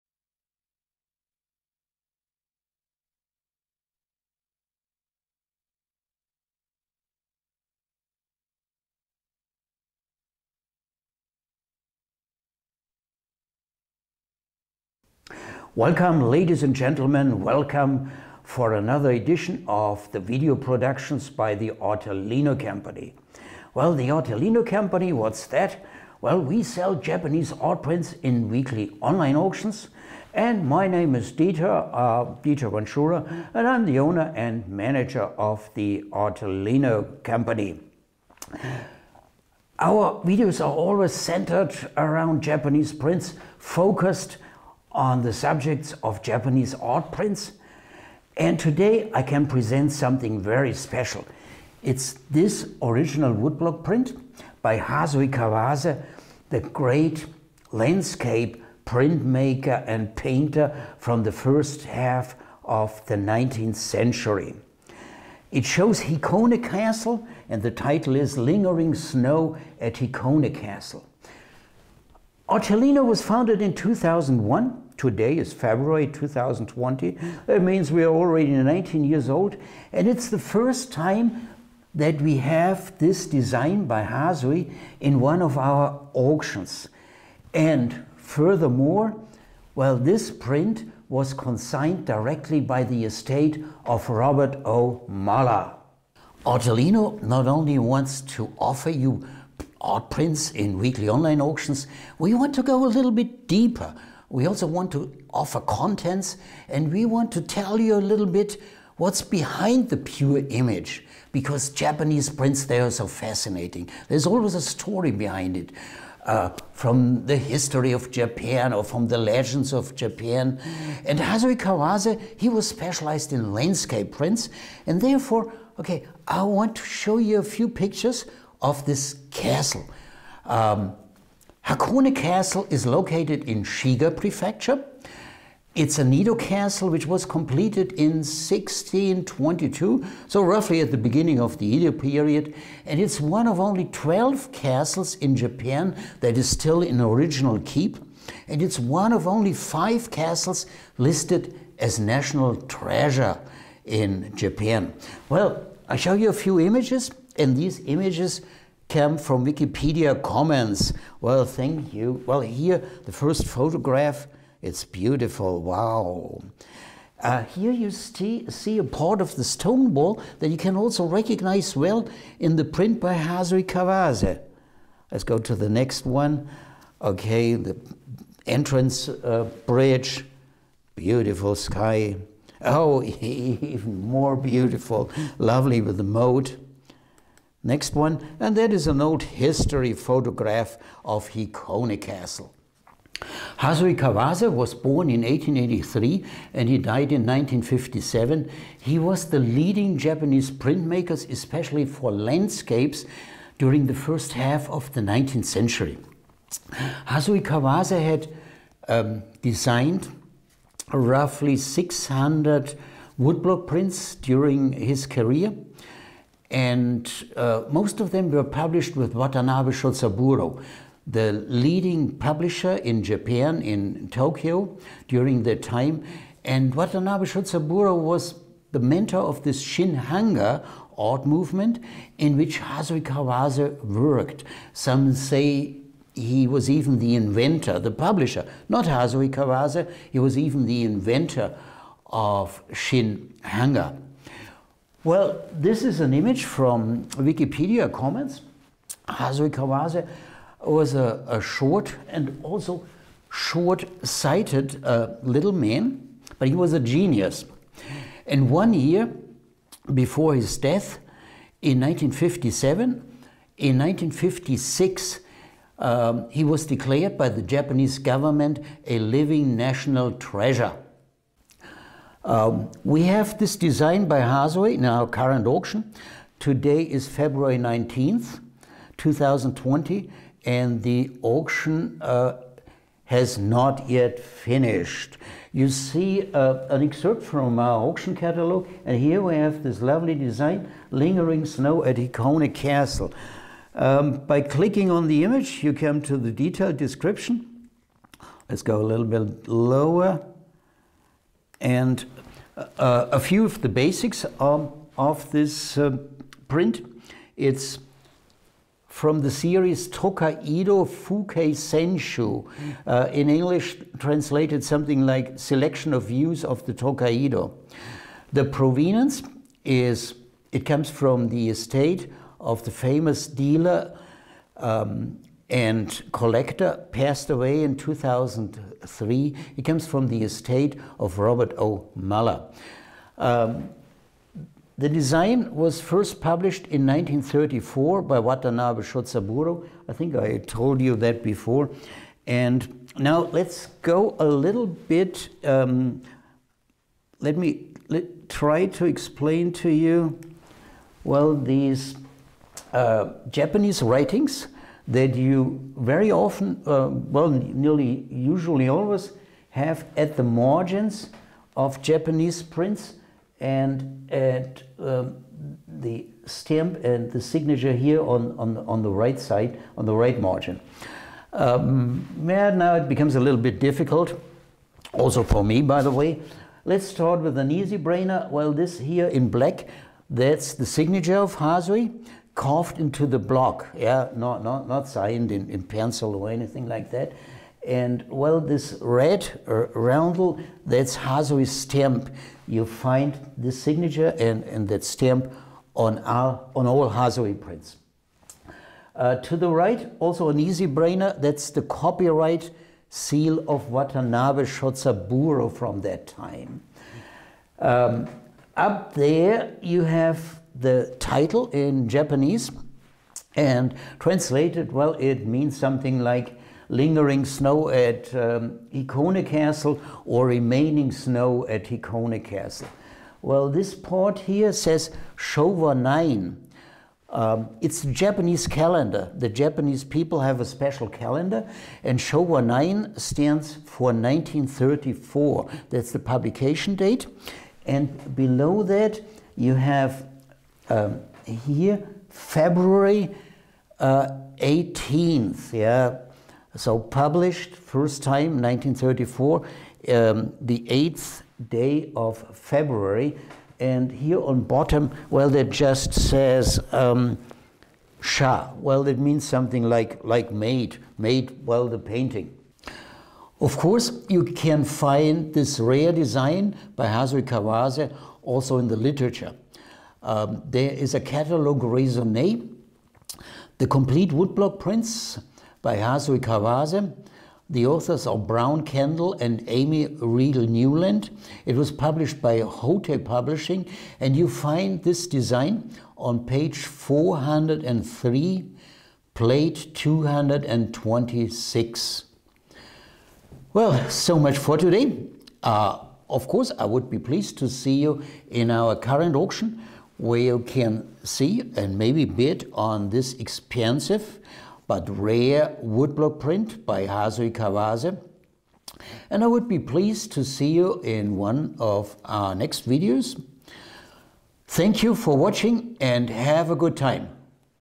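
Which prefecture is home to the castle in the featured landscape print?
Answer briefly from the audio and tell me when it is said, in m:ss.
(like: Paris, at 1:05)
Shiga Prefecture, at 2:13.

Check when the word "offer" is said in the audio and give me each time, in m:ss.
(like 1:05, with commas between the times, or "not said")
1:38, 1:45.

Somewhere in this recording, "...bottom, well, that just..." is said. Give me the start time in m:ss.
7:34.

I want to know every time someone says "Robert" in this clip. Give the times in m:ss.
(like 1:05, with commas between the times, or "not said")
1:34, 5:31.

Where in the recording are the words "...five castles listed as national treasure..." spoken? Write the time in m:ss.
2:29.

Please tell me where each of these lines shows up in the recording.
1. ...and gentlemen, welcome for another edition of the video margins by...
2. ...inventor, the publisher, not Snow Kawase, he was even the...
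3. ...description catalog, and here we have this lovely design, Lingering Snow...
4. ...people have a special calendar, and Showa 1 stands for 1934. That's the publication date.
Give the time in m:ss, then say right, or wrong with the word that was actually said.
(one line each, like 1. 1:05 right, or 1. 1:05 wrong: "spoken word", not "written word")
1. 0:16 wrong: "productions", not "margins"
2. 3:57 wrong: "Hasui", not "Snow"
3. 4:47 wrong: "auction", not "description"
4. 7:09 wrong: "9", not "1".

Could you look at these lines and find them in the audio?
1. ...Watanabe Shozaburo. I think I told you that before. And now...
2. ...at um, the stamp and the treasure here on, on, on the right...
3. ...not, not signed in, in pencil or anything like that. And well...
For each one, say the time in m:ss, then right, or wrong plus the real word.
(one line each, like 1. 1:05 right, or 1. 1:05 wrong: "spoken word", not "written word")
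1. 5:38 right
2. 6:04 wrong: "signature", not "treasure"
3. 6:24 right.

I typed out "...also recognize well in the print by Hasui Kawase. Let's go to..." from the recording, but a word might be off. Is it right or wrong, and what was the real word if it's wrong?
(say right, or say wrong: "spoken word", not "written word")
right.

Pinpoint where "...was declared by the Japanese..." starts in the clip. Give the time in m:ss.
4:26.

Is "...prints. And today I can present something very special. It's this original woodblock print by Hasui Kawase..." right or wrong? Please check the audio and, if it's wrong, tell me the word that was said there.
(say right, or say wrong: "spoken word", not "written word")
right.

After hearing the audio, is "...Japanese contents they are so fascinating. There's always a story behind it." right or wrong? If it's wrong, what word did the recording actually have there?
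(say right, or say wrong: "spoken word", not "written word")
wrong: "prints", not "contents".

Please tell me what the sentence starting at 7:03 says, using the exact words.
Well, this part here says Showa 9.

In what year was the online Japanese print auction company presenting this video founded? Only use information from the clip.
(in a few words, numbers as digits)
2001.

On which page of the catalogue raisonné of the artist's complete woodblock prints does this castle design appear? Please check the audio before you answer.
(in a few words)
403.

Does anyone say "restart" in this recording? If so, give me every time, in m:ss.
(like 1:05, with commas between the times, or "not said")
not said.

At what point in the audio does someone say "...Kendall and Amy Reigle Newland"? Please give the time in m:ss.
7:58.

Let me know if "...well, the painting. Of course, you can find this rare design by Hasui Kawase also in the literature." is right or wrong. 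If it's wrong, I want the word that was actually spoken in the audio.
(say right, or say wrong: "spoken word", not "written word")
right.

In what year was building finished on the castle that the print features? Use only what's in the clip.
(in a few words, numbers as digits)
1622.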